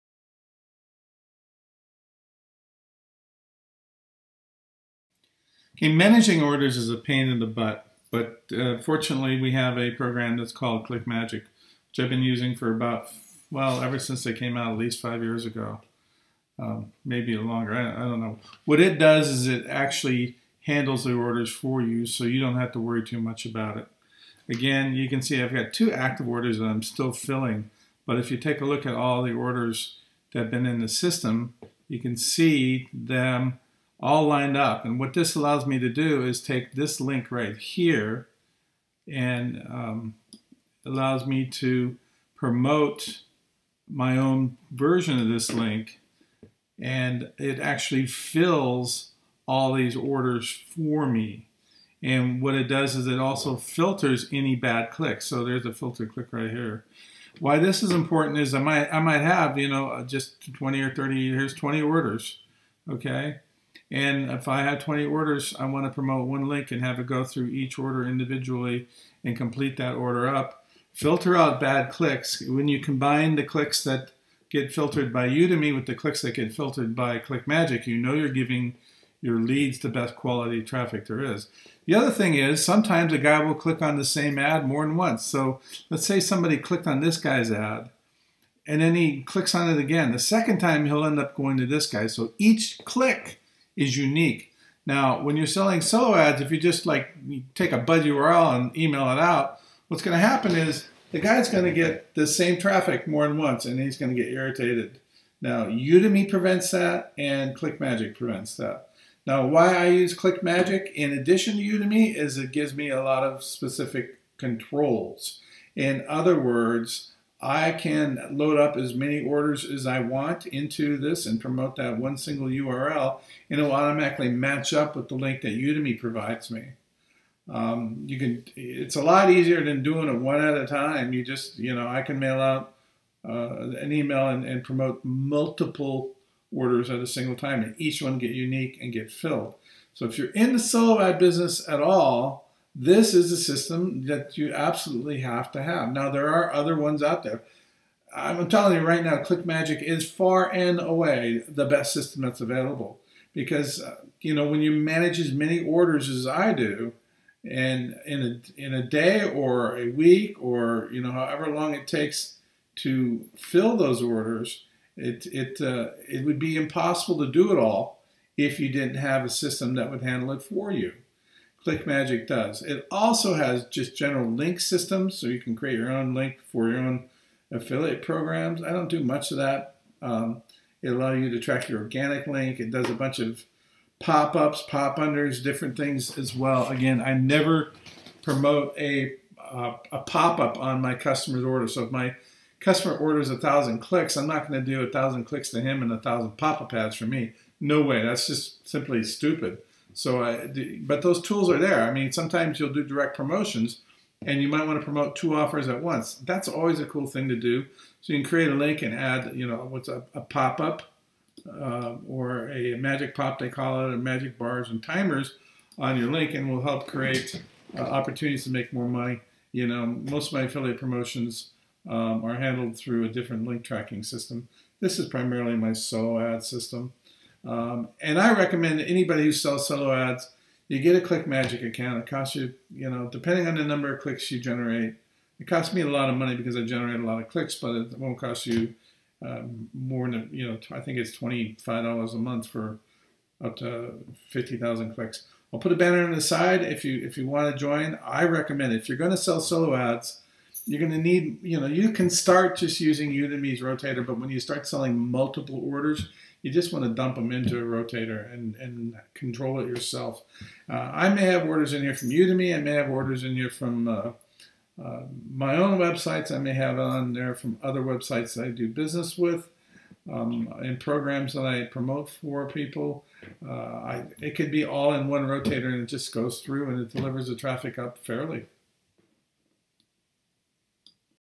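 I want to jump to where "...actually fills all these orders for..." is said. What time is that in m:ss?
0:47.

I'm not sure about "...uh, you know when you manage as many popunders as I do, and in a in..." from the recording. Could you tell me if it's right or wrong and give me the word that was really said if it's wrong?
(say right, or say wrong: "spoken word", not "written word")
wrong: "orders", not "popunders".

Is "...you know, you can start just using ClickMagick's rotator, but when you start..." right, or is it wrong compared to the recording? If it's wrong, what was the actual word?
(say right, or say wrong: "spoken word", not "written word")
wrong: "Udimi", not "ClickMagick".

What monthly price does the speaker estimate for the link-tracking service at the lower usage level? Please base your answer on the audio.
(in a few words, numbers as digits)
$25.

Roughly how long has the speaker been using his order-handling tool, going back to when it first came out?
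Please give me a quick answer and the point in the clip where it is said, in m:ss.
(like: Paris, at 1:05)
5 years, at 0:15.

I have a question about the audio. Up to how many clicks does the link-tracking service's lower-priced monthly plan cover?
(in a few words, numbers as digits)
50,000.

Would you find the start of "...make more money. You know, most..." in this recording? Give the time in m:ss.
3:38.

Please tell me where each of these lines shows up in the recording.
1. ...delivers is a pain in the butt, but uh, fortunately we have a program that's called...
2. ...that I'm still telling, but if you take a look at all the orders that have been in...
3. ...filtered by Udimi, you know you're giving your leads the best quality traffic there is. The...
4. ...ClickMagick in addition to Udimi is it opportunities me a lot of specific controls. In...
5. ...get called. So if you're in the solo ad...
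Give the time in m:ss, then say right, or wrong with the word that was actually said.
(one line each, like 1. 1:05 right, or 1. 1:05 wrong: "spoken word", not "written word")
1. 0:06 wrong: "orders", not "delivers"
2. 0:26 wrong: "filling", not "telling"
3. 1:16 wrong: "ClickMagick", not "Udimi"
4. 1:50 wrong: "gives", not "opportunities"
5. 2:18 wrong: "filled", not "called".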